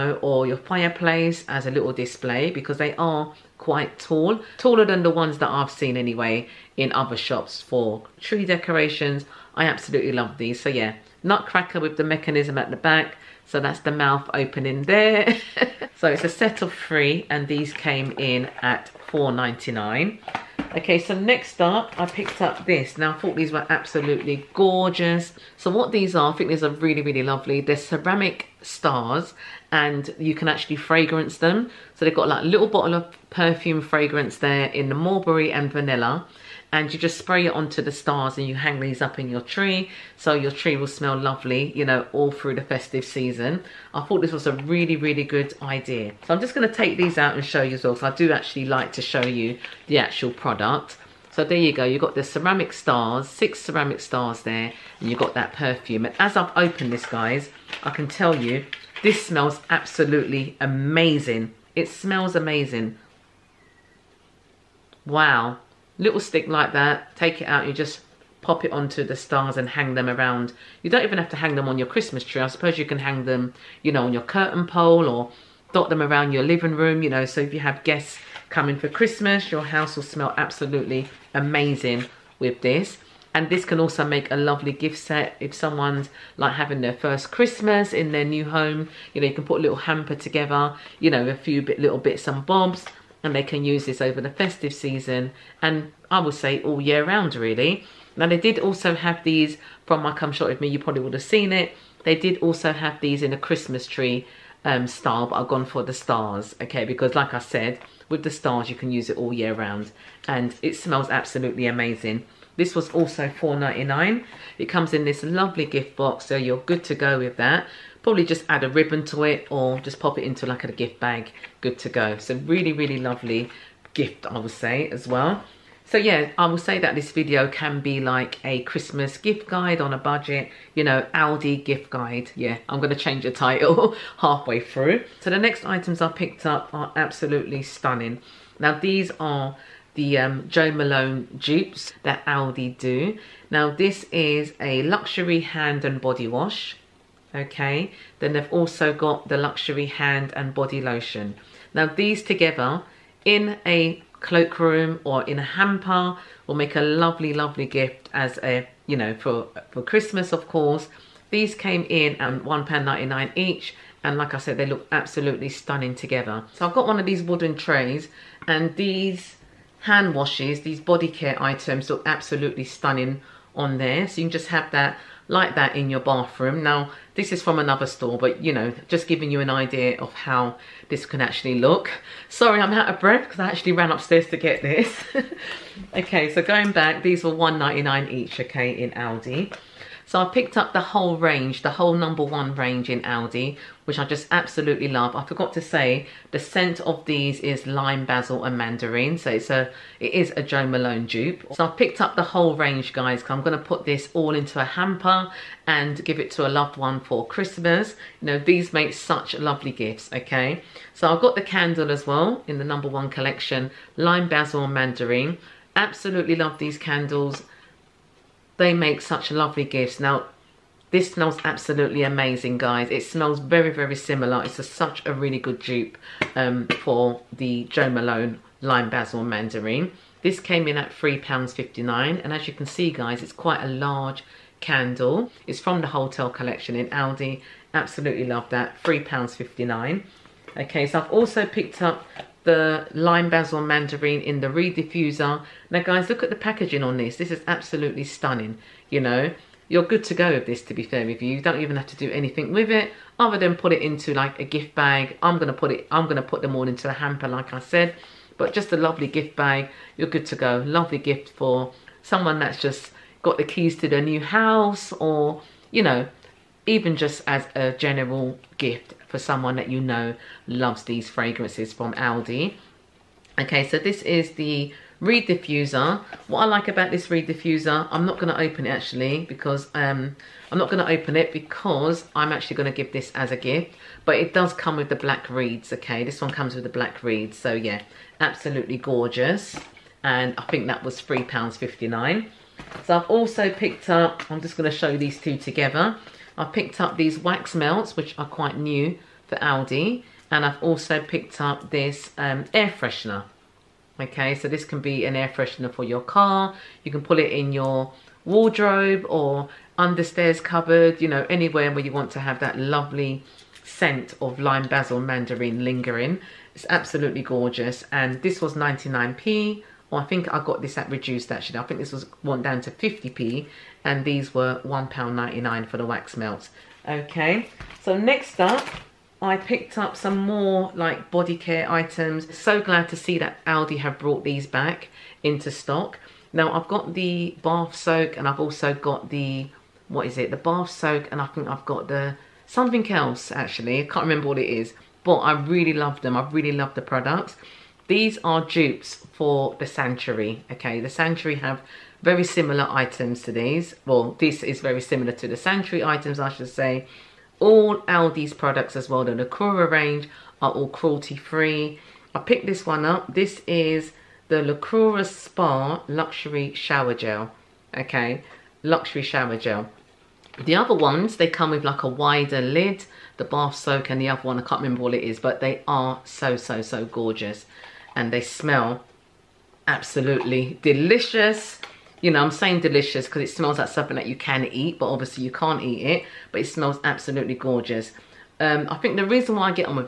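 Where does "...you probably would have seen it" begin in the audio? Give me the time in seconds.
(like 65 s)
100 s.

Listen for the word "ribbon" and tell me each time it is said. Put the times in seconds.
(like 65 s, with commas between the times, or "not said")
118 s.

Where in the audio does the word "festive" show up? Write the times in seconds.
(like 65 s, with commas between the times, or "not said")
42 s, 94 s.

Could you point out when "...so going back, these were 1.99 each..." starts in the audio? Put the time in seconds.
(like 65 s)
186 s.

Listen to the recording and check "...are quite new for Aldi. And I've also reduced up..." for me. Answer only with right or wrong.
wrong.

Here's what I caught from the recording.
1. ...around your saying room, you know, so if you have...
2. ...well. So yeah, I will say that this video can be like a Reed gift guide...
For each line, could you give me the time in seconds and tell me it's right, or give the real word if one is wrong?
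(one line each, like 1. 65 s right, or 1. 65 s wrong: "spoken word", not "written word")
1. 76 s wrong: "living", not "saying"
2. 125 s wrong: "Christmas", not "Reed".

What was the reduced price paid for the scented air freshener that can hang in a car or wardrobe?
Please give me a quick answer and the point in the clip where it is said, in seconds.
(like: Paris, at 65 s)
50p, at 322 s.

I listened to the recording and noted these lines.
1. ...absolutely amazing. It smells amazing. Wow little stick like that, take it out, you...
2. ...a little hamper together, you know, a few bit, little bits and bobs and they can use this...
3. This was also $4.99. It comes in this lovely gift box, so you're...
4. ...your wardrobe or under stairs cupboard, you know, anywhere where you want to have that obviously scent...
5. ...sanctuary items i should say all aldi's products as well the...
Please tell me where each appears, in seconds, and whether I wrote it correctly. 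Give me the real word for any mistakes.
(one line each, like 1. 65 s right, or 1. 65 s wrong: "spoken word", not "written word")
1. 59 s right
2. 89 s right
3. 112 s right
4. 307 s wrong: "lovely", not "obviously"
5. 355 s right.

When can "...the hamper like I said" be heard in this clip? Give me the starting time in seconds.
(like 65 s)
256 s.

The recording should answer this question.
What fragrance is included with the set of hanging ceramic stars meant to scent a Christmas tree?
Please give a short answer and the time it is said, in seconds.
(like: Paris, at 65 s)
mulberry and vanilla, at 34 s.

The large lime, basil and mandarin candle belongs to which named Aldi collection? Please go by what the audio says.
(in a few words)
Hotel collection.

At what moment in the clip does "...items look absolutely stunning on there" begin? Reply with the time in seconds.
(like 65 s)
171 s.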